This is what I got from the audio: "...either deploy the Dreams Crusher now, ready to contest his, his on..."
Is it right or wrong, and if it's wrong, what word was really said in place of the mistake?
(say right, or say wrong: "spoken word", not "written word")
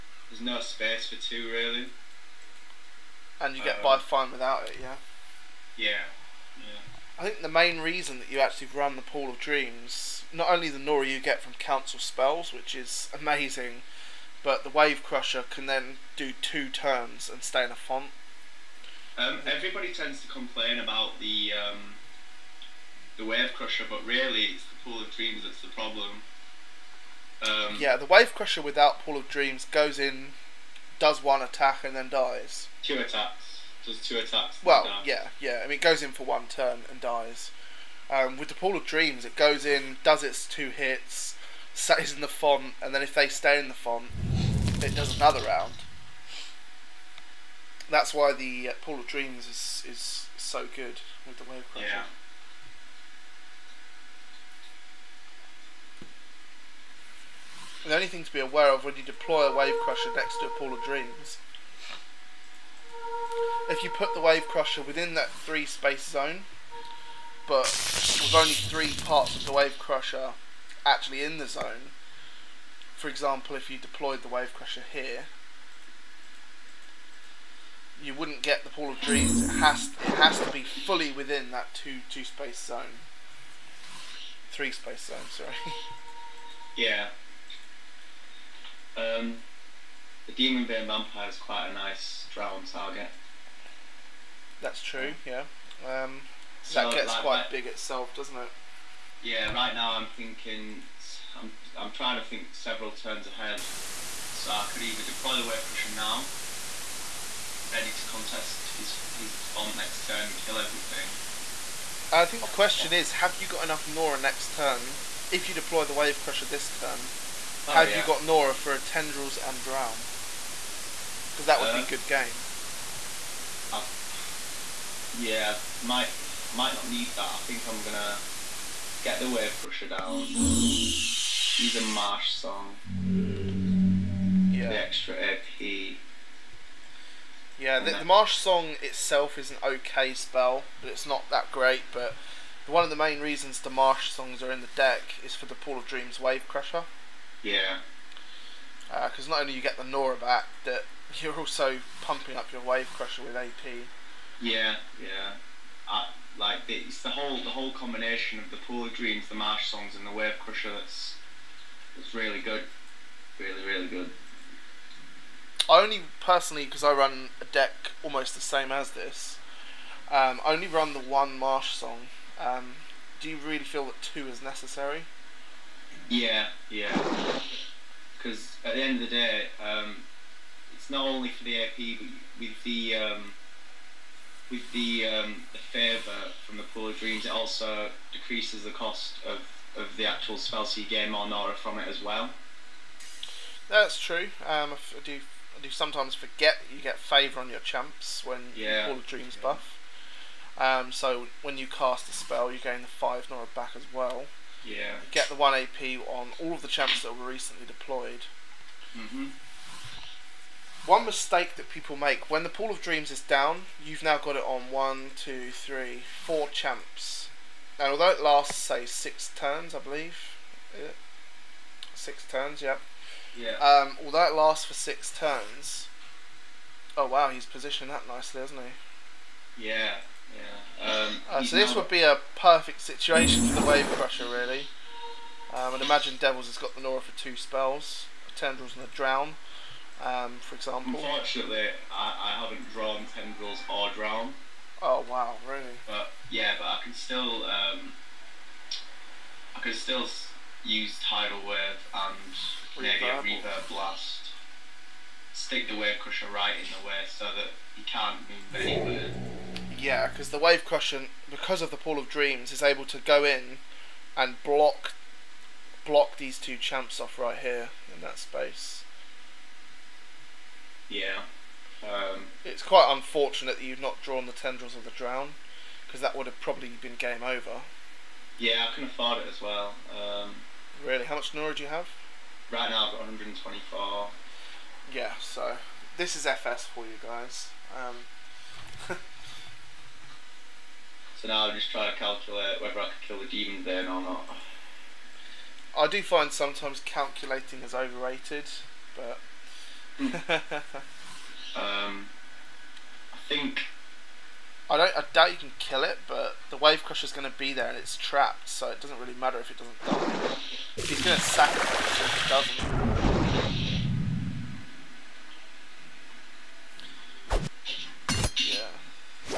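wrong: "Wave", not "Dreams".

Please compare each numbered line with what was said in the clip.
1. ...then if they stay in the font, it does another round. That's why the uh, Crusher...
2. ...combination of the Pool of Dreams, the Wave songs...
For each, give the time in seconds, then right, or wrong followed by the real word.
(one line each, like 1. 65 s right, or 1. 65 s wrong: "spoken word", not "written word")
1. 42 s wrong: "Pool", not "Crusher"
2. 157 s wrong: "Marsh", not "Wave".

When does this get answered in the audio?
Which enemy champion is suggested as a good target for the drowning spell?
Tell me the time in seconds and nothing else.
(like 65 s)
90 s.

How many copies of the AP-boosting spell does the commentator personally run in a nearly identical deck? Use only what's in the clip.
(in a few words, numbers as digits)
1.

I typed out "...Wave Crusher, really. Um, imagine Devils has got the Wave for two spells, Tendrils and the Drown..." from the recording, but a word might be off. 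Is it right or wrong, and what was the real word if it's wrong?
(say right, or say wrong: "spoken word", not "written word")
wrong: "Nora", not "Wave".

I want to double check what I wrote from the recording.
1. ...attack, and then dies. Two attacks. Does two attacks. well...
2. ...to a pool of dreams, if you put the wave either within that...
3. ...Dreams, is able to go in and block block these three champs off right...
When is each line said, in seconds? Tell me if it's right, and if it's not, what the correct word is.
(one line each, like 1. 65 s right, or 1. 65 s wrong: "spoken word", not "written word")
1. 31 s right
2. 60 s wrong: "crusher", not "either"
3. 262 s wrong: "two", not "three".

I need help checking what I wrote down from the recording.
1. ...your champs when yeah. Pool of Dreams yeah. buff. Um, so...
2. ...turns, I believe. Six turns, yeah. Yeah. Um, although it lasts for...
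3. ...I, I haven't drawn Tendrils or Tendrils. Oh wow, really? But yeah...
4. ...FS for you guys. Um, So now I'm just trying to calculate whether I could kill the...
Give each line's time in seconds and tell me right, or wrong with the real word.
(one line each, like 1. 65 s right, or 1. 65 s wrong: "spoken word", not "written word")
1. 197 s right
2. 219 s right
3. 241 s wrong: "Drown", not "Tendrils"
4. 286 s right.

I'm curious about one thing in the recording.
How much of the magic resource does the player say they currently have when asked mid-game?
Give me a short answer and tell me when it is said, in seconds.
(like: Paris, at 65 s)
124, at 283 s.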